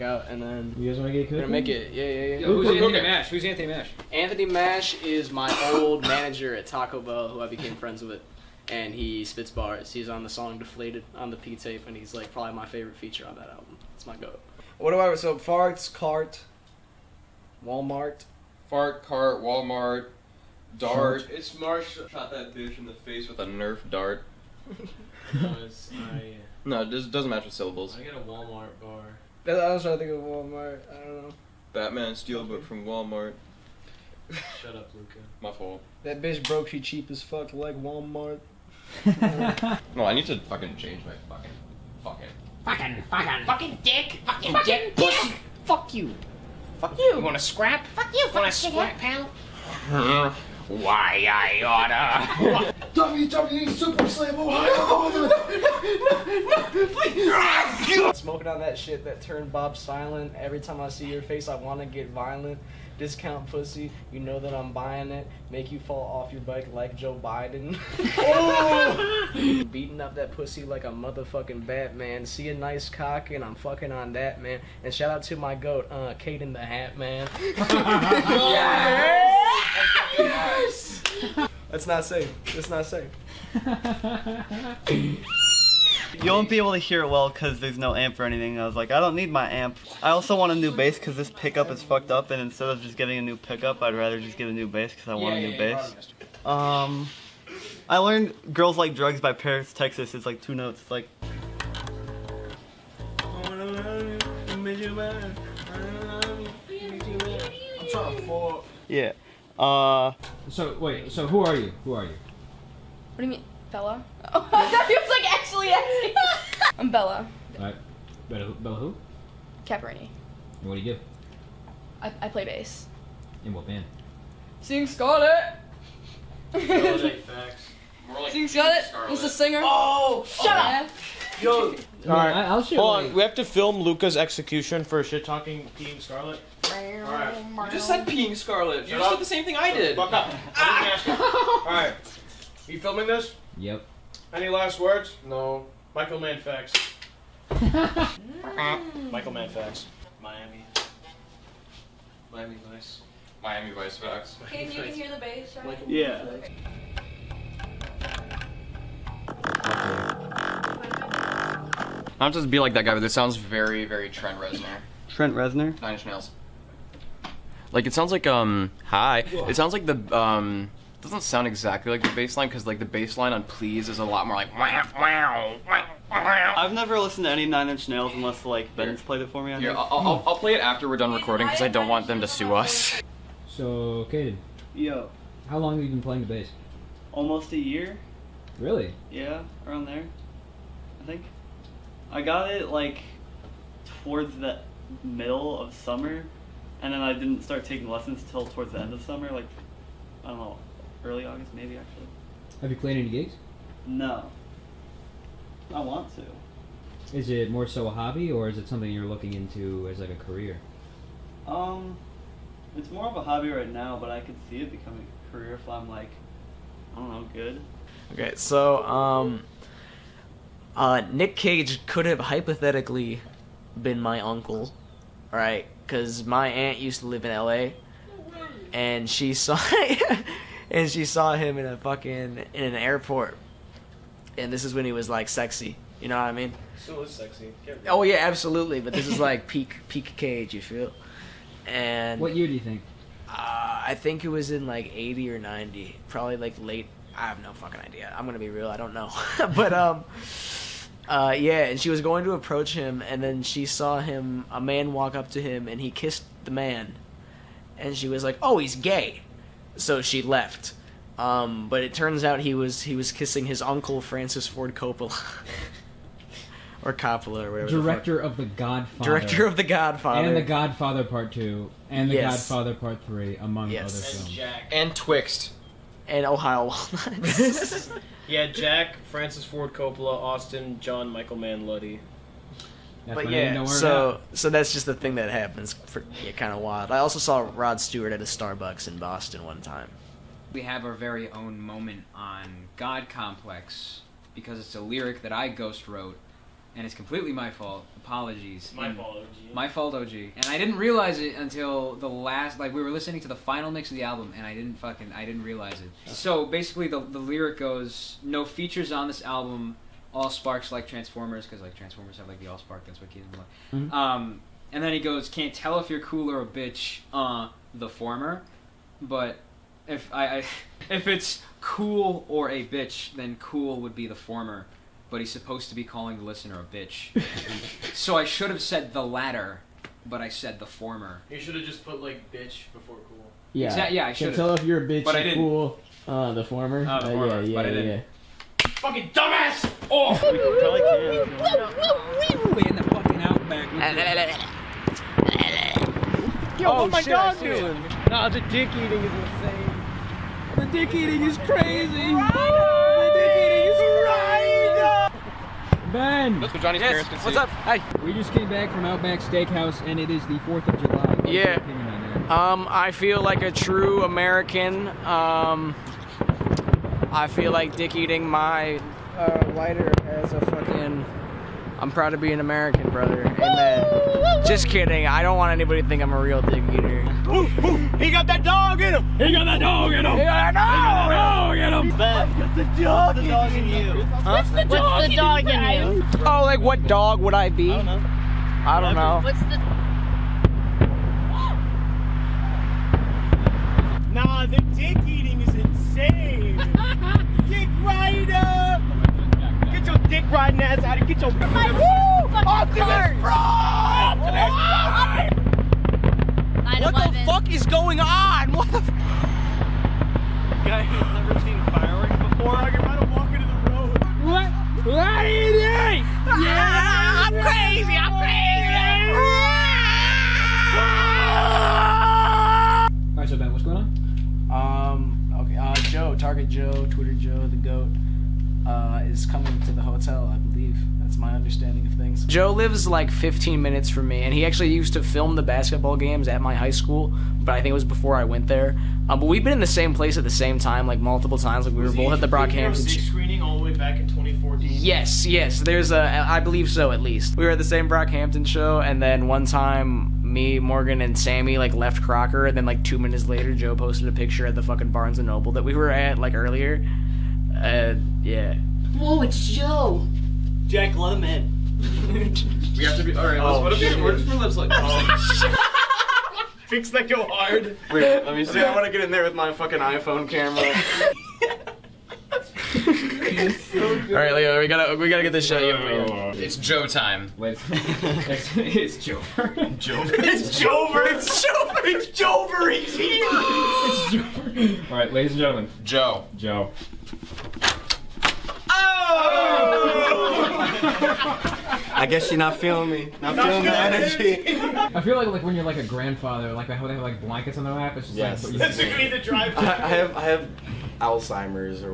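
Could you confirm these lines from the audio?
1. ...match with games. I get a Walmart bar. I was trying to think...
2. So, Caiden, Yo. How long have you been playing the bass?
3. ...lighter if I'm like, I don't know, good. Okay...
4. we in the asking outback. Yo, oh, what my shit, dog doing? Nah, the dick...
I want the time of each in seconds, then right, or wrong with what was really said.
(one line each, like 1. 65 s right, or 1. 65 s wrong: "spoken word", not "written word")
1. 27 s wrong: "syllables", not "games"
2. 183 s right
3. 215 s wrong: "career", not "lighter"
4. 342 s wrong: "fucking", not "asking".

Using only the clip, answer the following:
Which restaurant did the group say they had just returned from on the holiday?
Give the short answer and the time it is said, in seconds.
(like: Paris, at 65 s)
Outback Steakhouse, at 358 s.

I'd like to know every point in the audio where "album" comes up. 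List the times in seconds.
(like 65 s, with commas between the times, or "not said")
13 s, 304 s, 309 s.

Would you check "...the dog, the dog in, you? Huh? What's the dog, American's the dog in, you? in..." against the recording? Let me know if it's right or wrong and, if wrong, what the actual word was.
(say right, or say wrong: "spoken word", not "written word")
wrong: "What", not "American".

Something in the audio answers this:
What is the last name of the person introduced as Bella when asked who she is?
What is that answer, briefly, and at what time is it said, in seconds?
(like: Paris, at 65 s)
Caporini, at 119 s.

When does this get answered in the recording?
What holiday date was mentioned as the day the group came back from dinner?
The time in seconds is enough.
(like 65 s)
360 s.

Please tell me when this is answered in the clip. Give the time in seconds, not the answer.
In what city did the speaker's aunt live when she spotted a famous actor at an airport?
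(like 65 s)
227 s.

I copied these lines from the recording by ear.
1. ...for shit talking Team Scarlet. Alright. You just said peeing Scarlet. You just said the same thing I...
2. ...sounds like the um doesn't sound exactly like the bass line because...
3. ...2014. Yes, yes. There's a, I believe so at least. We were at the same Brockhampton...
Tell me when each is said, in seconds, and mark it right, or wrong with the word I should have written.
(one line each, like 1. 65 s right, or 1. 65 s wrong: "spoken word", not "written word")
1. 134 s right
2. 169 s right
3. 444 s right.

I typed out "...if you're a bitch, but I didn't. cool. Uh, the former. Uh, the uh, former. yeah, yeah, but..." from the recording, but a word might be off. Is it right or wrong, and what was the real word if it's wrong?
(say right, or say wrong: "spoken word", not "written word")
right.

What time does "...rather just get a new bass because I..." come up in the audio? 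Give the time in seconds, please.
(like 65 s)
93 s.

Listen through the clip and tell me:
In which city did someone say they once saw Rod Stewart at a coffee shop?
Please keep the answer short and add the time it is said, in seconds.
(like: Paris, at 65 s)
Boston, at 288 s.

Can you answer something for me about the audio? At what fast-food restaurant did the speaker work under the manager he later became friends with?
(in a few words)
Taco Bell.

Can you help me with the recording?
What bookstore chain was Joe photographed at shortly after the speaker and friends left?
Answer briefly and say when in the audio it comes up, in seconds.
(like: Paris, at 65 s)
Barnes and Noble, at 454 s.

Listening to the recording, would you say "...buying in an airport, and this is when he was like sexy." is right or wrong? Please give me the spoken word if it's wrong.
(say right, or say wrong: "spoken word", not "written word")
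wrong: "fucking", not "buying".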